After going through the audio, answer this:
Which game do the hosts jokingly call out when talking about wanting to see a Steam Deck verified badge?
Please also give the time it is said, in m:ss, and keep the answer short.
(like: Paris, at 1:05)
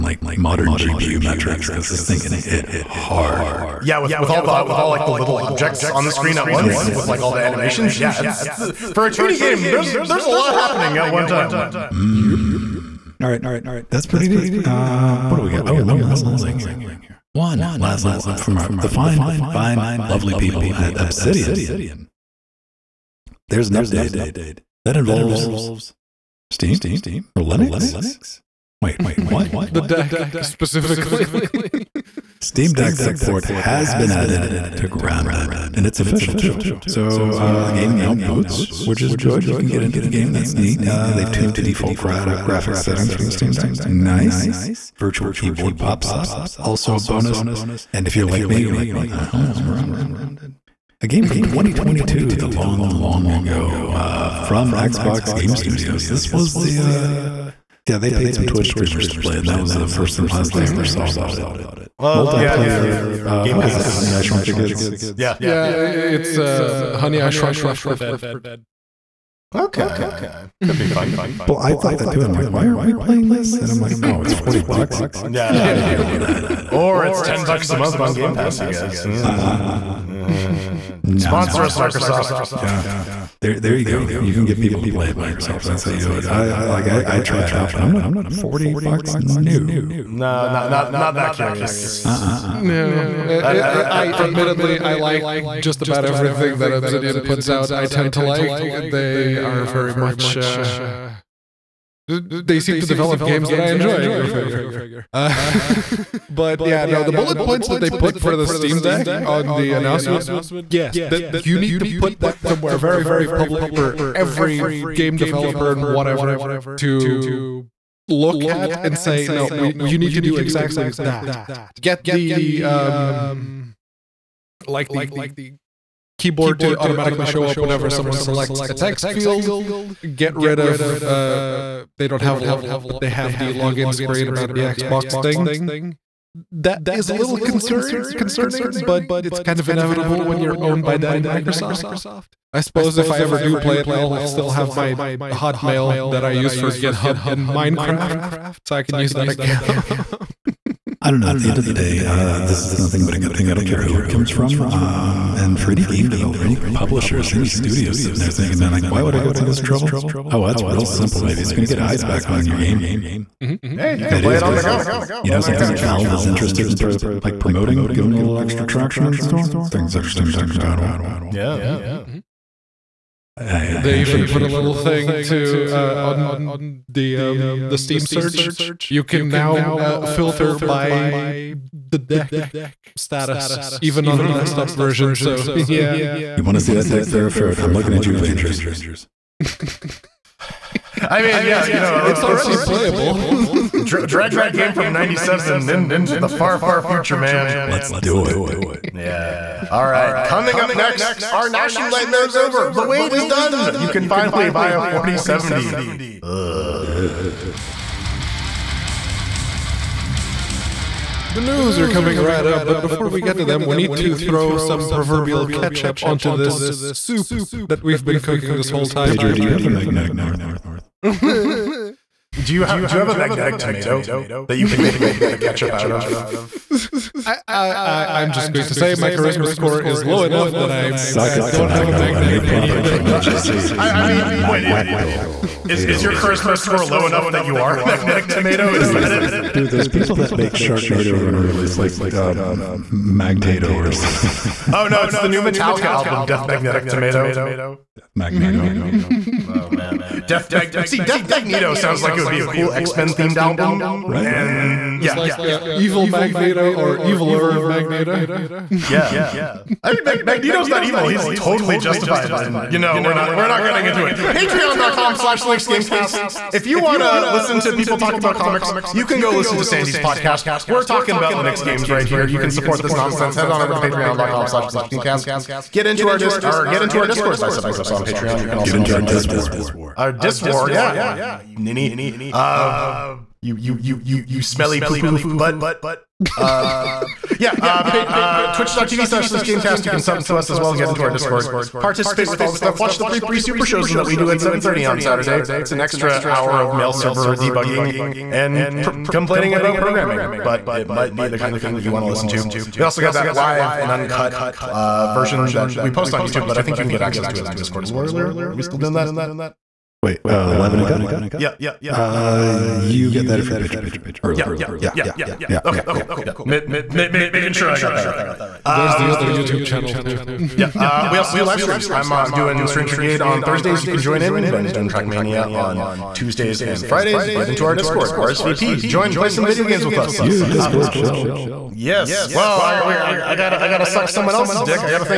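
Avengers, at 3:08.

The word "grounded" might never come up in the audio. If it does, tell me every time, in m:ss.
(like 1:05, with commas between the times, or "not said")
0:34, 0:49.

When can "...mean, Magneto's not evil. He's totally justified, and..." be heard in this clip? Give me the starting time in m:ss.
4:20.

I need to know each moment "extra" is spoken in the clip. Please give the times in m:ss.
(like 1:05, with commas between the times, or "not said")
2:48, 4:55.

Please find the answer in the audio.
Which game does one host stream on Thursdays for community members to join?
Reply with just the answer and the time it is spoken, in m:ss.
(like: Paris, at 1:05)
Strange Brigade, at 5:22.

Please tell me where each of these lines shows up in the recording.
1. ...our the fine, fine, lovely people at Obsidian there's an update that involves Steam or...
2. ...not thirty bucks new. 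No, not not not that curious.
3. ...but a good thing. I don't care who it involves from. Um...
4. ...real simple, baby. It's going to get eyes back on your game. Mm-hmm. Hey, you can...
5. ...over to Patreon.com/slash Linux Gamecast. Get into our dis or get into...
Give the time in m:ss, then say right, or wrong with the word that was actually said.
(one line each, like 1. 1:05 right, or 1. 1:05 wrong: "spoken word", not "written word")
1. 0:18 right
2. 1:27 wrong: "forty", not "thirty"
3. 2:33 wrong: "comes", not "involves"
4. 2:40 right
5. 4:33 right.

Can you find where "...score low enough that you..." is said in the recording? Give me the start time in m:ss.
3:56.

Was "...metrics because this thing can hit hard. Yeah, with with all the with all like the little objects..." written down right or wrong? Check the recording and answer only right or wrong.
right.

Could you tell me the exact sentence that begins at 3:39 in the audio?
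Pager, do you have a magnetic north?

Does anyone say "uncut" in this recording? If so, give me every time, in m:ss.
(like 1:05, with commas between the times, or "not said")
5:03, 5:10.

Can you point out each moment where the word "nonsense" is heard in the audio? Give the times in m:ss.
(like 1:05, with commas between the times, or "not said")
4:32.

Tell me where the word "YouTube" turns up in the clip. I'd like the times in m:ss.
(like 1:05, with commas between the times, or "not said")
5:06, 5:19.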